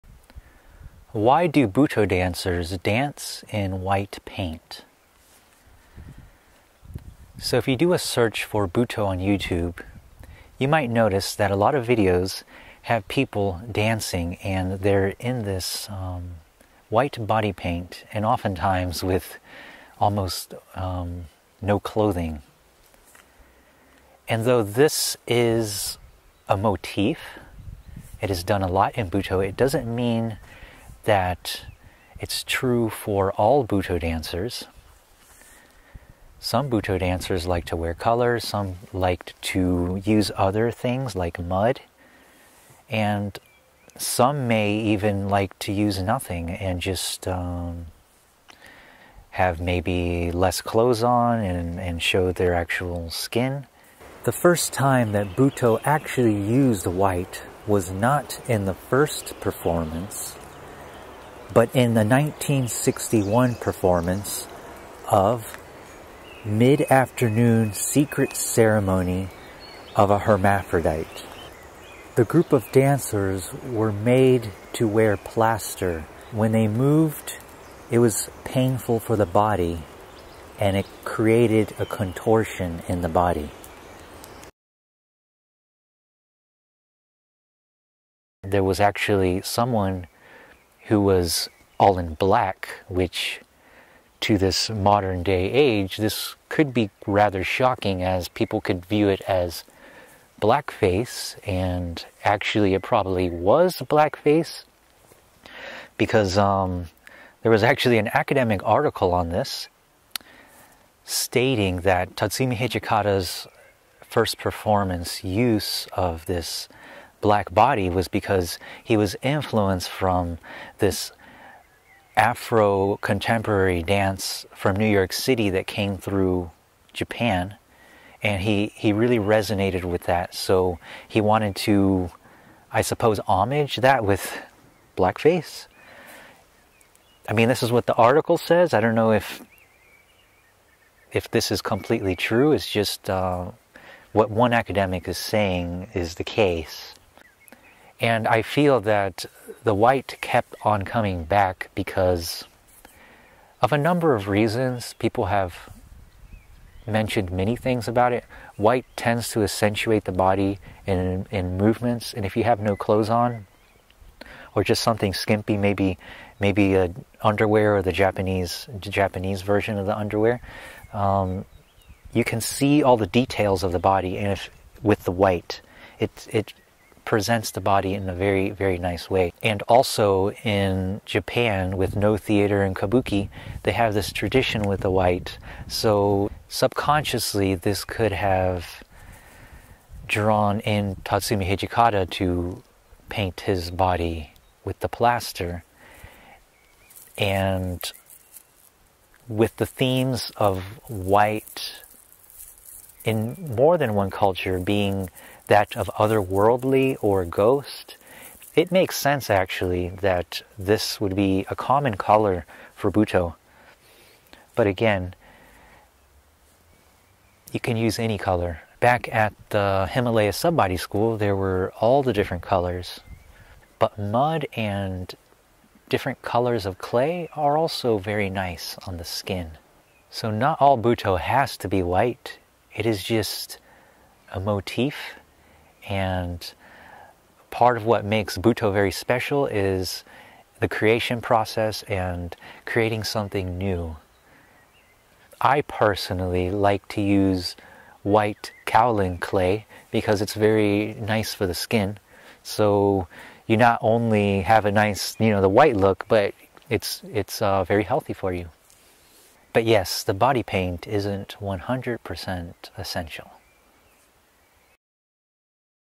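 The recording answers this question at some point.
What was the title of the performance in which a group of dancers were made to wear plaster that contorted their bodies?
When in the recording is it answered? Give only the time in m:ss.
1:06.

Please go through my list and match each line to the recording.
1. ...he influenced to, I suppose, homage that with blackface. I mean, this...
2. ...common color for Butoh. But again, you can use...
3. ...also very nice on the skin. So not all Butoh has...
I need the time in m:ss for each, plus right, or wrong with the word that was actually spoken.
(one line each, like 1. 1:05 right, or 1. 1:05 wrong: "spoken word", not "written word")
1. 2:11 wrong: "wanted", not "influenced"
2. 3:31 right
3. 3:47 right.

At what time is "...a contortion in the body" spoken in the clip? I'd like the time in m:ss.
1:21.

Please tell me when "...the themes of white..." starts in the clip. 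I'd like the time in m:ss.
3:19.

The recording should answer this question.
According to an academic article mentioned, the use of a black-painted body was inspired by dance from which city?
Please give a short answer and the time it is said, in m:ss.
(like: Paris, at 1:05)
New York City, at 2:04.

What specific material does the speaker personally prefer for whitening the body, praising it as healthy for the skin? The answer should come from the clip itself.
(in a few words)
white kaolin clay.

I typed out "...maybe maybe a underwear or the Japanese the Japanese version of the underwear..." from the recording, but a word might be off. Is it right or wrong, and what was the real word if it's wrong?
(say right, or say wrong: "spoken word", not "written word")
right.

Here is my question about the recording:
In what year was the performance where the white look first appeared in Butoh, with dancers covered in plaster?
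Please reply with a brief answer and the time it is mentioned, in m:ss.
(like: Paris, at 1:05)
1961, at 1:02.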